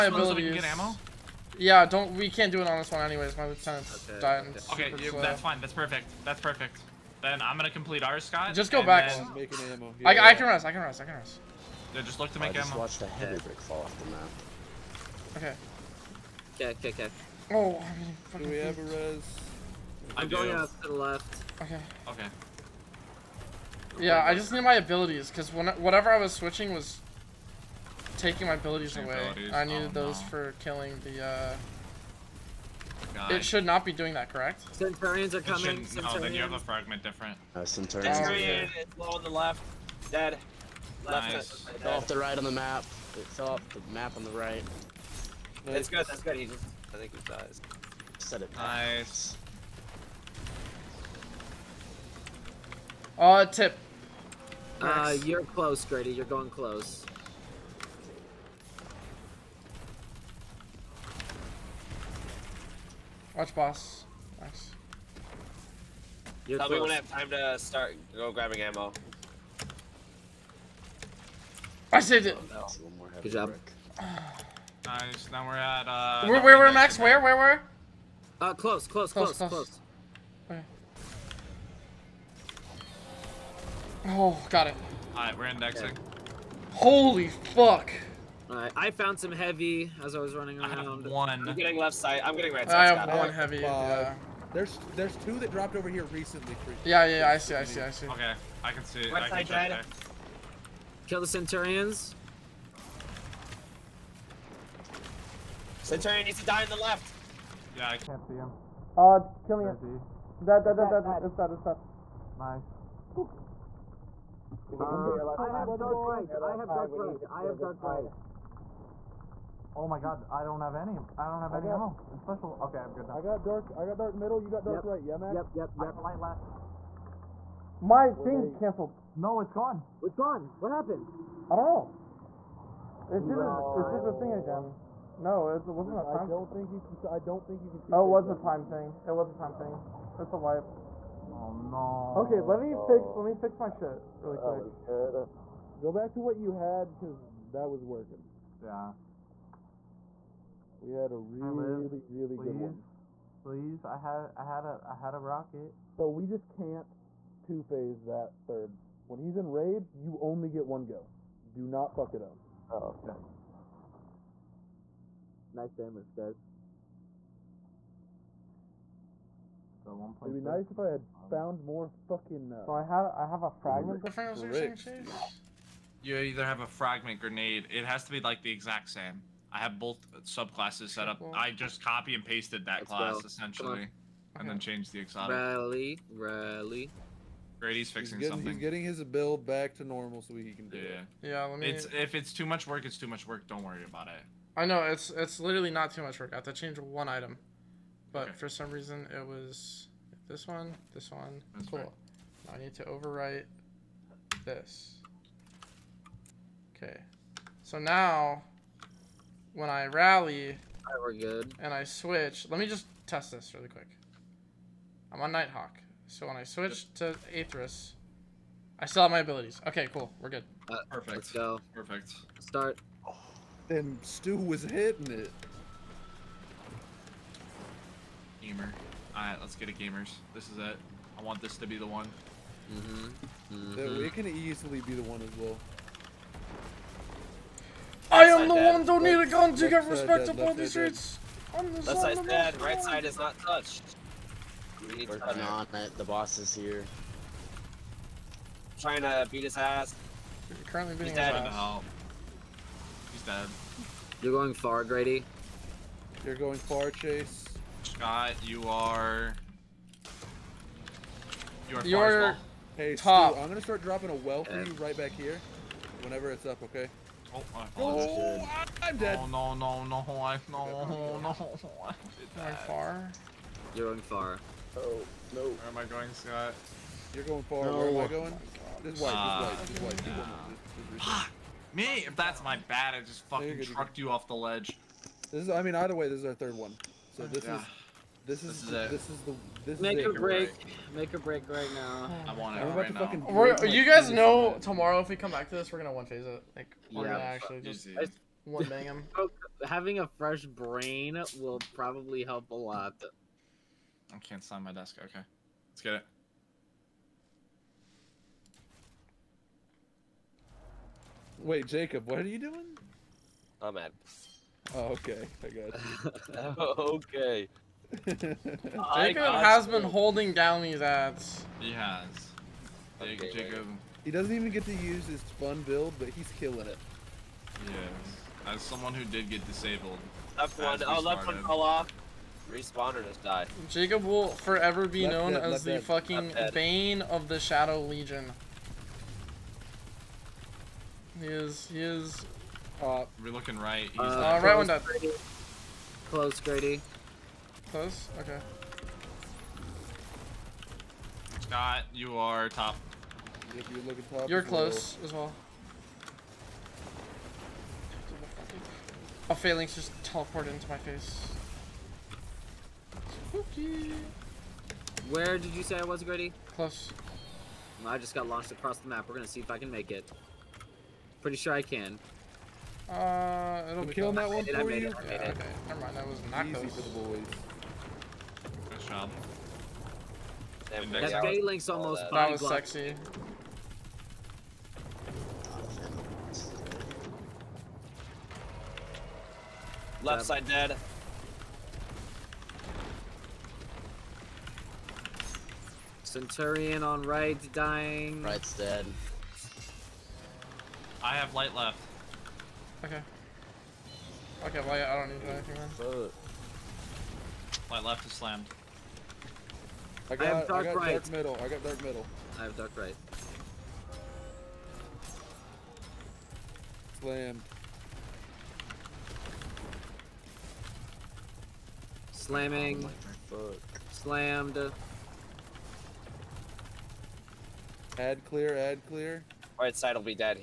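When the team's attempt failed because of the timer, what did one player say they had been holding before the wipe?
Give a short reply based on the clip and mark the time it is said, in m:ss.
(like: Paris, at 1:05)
A rocket, at 2:35.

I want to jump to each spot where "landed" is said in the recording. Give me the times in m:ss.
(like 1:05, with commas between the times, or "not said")
not said.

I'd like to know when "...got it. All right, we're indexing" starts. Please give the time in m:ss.
1:24.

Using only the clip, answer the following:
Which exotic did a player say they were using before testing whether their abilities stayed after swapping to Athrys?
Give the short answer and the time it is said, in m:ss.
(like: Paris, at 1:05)
Nighthawk, at 3:35.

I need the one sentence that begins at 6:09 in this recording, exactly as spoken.
We're gonna see if I can make it.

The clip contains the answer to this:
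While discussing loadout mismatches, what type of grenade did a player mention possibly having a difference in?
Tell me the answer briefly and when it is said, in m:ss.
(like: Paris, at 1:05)
Fragment grenade, at 2:56.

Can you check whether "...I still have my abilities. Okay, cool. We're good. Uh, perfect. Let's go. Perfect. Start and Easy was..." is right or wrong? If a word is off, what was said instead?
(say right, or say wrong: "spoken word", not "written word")
wrong: "Stu", not "Easy".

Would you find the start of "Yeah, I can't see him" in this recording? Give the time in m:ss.
1:47.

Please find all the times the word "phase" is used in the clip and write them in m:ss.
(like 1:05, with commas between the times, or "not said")
2:37, 4:56.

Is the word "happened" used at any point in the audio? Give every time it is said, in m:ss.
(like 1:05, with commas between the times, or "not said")
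2:10.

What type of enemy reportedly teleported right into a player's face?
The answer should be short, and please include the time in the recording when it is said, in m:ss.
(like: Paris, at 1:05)
Phalanx, at 5:59.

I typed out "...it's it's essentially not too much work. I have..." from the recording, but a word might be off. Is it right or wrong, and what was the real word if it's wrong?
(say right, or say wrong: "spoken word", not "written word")
wrong: "literally", not "essentially".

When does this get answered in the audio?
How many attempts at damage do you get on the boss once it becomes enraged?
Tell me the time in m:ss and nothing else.
2:40.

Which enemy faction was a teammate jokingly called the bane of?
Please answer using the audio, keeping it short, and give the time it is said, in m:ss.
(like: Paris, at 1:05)
Shadow Legion, at 5:37.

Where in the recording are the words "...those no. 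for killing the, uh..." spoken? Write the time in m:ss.
0:30.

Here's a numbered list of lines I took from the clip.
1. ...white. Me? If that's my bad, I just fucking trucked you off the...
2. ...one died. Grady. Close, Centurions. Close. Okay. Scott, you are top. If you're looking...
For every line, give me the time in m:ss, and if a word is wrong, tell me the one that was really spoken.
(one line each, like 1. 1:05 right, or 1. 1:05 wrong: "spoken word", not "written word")
1. 4:41 right
2. 5:44 wrong: "Grady", not "Centurions".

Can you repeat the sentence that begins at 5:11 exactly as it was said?
Wait, Jacob, what are you doing?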